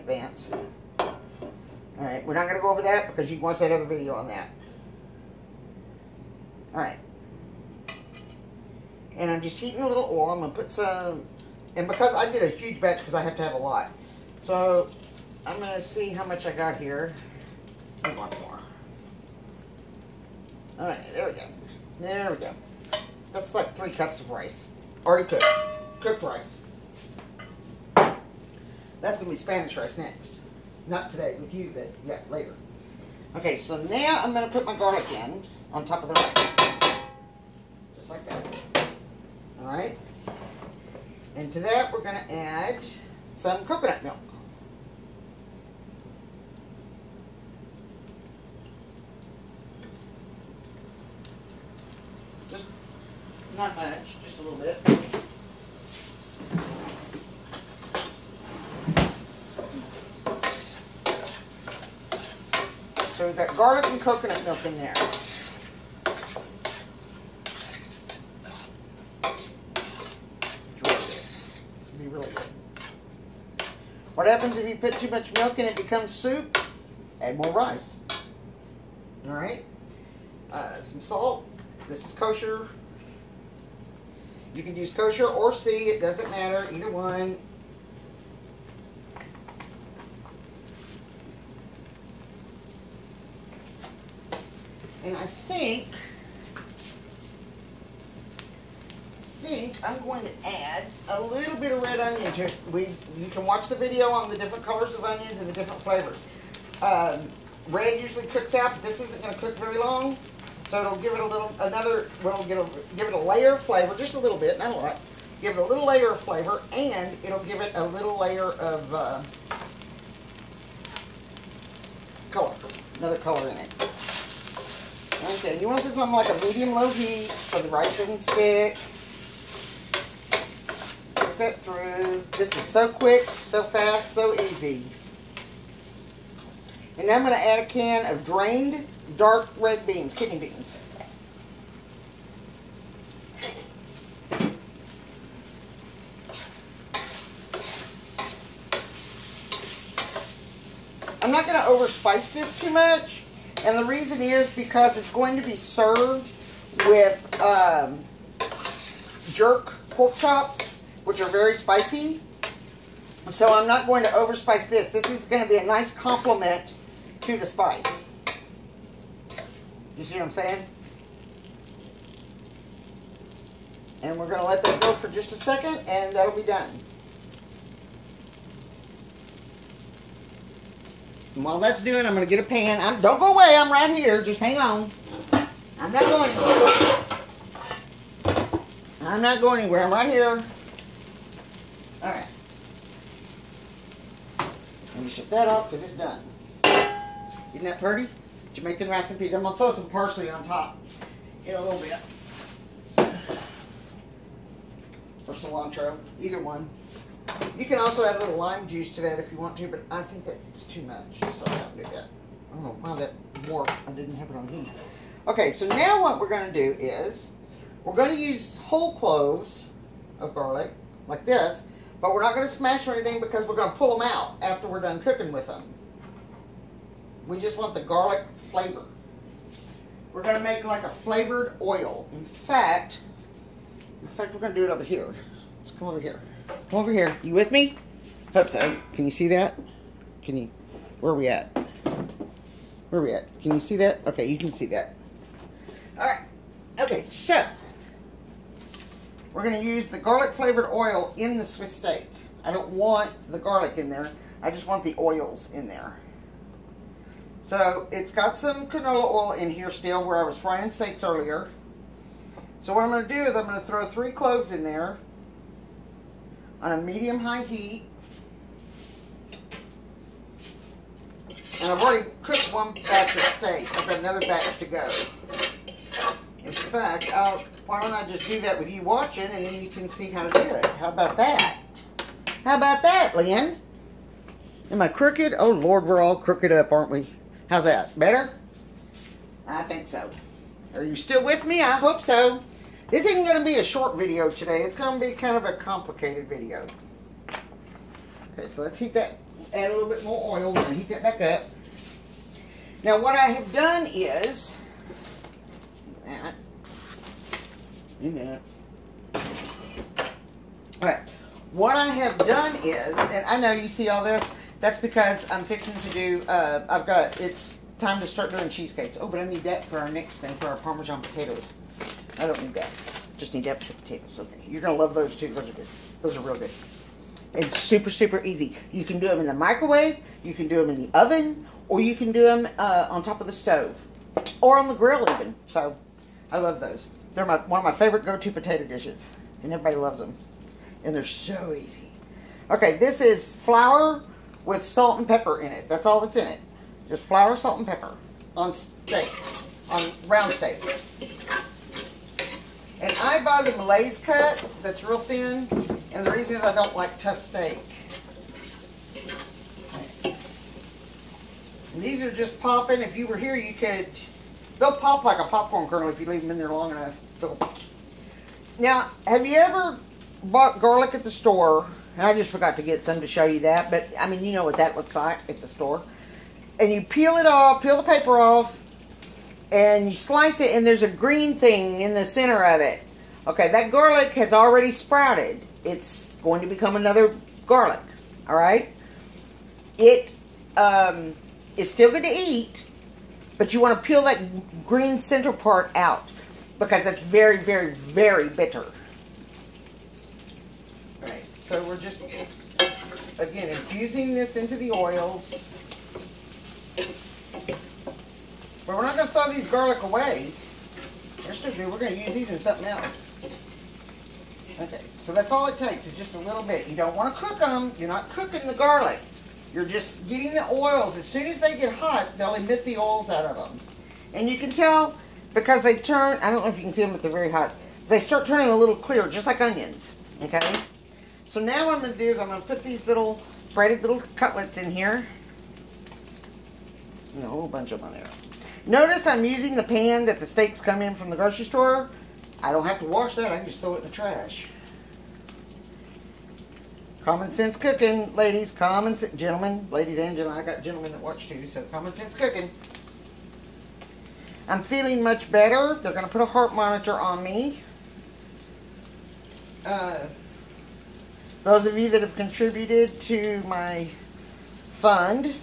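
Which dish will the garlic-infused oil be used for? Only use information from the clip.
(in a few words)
Swiss steak.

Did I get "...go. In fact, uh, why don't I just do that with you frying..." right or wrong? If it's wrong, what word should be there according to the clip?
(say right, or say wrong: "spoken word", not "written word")
wrong: "watching", not "frying".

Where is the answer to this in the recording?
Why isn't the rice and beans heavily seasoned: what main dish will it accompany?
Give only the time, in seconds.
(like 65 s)
159 s.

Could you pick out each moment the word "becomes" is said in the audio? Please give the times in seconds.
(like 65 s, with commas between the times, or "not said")
75 s, 386 s.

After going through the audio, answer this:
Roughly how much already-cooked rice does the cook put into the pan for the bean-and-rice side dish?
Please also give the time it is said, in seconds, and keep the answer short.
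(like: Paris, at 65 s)
3 cups, at 23 s.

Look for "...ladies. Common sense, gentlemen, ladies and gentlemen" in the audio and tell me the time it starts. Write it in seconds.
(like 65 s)
448 s.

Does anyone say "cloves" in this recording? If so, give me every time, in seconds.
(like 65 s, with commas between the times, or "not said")
218 s, 264 s.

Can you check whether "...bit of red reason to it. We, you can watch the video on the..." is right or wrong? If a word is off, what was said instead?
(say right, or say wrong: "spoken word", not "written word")
wrong: "onion", not "reason".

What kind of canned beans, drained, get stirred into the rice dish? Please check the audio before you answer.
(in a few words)
kidney beans.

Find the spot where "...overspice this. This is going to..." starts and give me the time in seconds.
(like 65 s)
164 s.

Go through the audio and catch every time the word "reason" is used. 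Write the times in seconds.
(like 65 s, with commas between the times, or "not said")
153 s, 356 s.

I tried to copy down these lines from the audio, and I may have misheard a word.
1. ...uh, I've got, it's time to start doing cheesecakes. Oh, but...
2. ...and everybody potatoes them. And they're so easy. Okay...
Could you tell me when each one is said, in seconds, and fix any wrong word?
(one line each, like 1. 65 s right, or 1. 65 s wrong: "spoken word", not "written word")
1. 316 s right
2. 339 s wrong: "loves", not "potatoes".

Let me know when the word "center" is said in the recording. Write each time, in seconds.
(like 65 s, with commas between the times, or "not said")
382 s, 394 s.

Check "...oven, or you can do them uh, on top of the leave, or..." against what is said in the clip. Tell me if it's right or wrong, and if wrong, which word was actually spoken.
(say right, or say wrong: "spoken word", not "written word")
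wrong: "stove", not "leave".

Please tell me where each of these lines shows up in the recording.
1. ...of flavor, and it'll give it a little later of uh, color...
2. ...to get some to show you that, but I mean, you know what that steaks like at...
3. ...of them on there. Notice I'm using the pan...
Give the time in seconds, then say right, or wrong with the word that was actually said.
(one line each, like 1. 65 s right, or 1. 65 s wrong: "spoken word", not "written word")
1. 116 s wrong: "layer", not "later"
2. 372 s wrong: "looks", not "steaks"
3. 437 s right.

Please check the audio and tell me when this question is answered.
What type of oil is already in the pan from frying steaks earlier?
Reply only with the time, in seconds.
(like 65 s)
258 s.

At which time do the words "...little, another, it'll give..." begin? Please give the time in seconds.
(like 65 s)
111 s.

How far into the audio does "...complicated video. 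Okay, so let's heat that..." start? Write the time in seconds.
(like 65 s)
295 s.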